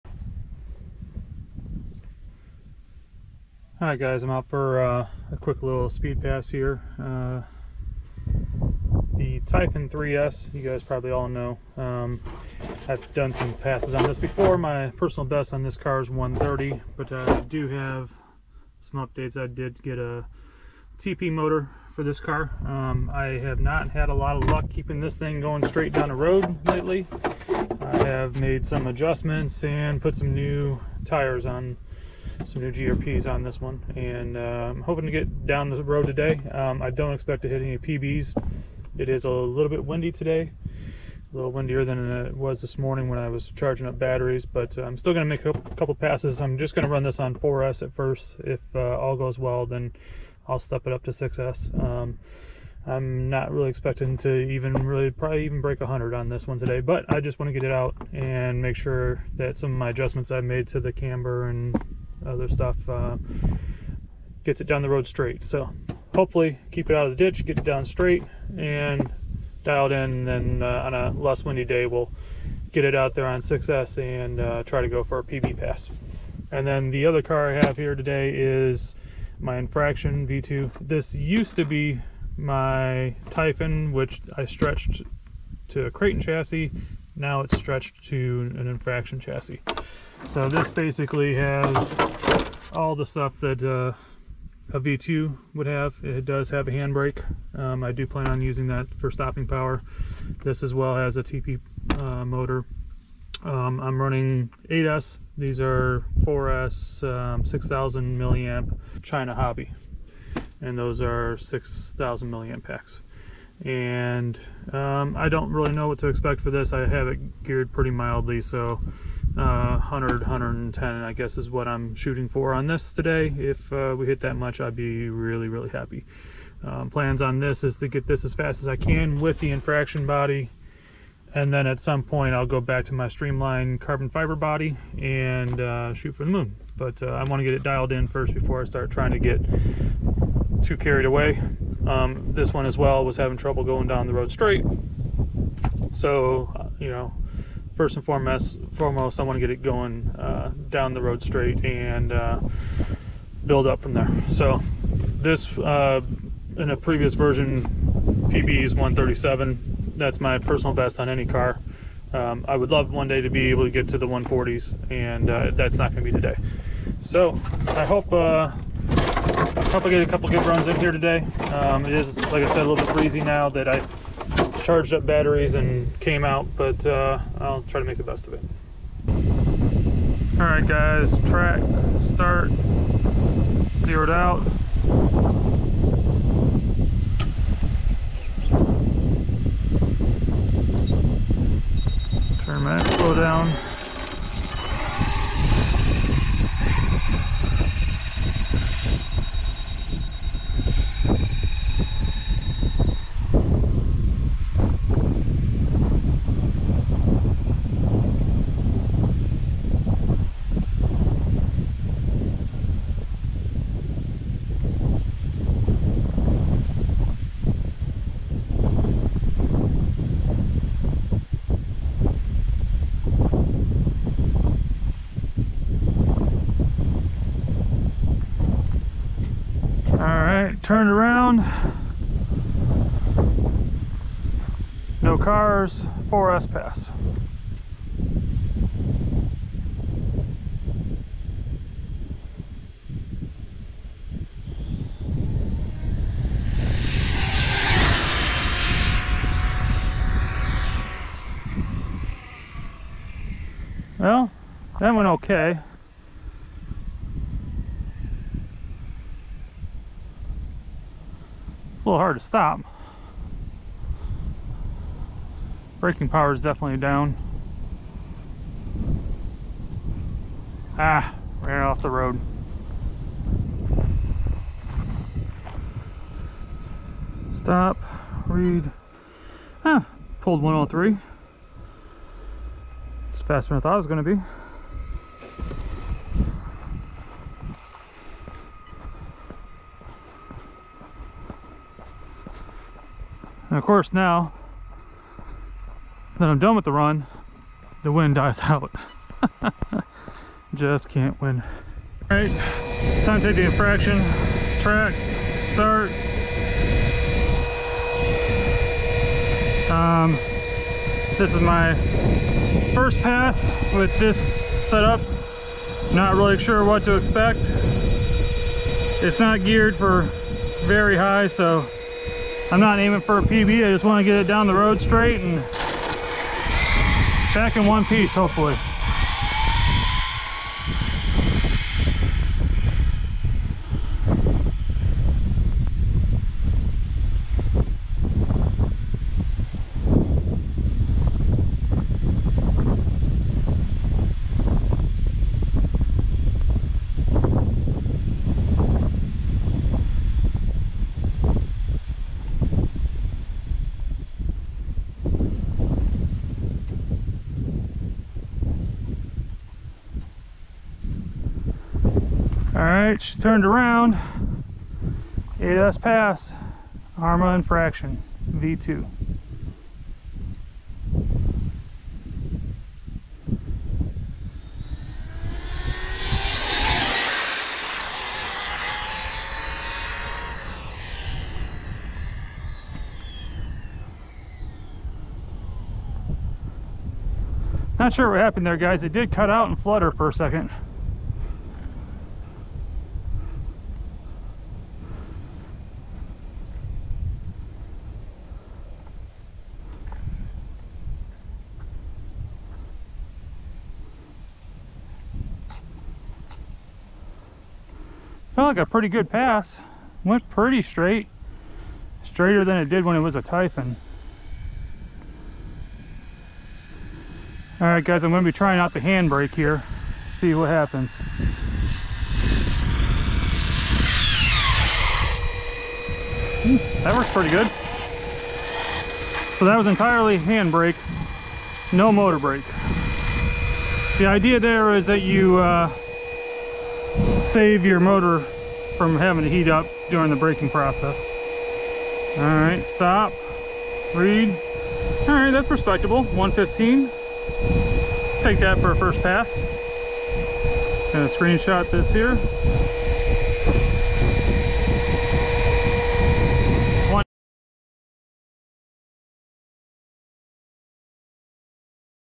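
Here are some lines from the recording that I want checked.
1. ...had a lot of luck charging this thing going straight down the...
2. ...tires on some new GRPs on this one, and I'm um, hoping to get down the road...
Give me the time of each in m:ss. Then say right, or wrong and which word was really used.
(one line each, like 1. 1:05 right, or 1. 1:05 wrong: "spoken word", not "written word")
1. 0:23 wrong: "keeping", not "charging"
2. 0:31 right.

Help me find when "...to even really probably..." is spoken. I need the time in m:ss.
0:54.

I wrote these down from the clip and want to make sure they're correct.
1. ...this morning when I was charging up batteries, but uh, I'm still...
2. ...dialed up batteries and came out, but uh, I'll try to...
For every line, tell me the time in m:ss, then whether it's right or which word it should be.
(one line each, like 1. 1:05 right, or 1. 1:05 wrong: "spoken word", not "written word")
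1. 0:42 right
2. 2:54 wrong: "charged", not "dialed".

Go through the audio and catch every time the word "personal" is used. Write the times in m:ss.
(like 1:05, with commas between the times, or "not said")
0:14, 2:40.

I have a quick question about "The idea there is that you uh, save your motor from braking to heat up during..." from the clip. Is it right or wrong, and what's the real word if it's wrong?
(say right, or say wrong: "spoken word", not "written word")
wrong: "having", not "braking".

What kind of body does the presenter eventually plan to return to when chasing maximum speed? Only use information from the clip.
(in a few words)
Streamline carbon fiber.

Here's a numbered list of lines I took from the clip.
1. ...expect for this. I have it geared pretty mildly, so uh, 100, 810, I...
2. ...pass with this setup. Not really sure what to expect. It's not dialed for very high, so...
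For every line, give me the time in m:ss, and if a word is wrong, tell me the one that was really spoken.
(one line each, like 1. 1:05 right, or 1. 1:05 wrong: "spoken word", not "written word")
1. 1:56 wrong: "110", not "810"
2. 5:13 wrong: "geared", not "dialed".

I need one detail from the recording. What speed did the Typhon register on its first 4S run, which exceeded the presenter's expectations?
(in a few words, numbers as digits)
103.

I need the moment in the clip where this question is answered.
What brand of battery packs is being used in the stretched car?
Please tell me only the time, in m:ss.
1:49.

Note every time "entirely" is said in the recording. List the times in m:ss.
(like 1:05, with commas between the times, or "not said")
7:09.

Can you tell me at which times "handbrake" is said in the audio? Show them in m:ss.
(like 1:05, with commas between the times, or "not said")
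1:36, 6:58, 7:10.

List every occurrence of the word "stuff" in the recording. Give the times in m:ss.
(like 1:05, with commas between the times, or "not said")
1:02, 1:33.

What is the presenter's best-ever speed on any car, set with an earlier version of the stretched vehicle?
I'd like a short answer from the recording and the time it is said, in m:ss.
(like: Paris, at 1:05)
137, at 2:38.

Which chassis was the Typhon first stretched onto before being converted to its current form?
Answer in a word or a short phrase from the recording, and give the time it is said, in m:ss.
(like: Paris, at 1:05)
Kraton, at 1:25.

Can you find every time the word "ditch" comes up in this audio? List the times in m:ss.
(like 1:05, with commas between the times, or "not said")
1:07.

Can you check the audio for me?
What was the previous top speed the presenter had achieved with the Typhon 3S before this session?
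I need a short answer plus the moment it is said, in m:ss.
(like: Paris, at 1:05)
130, at 0:16.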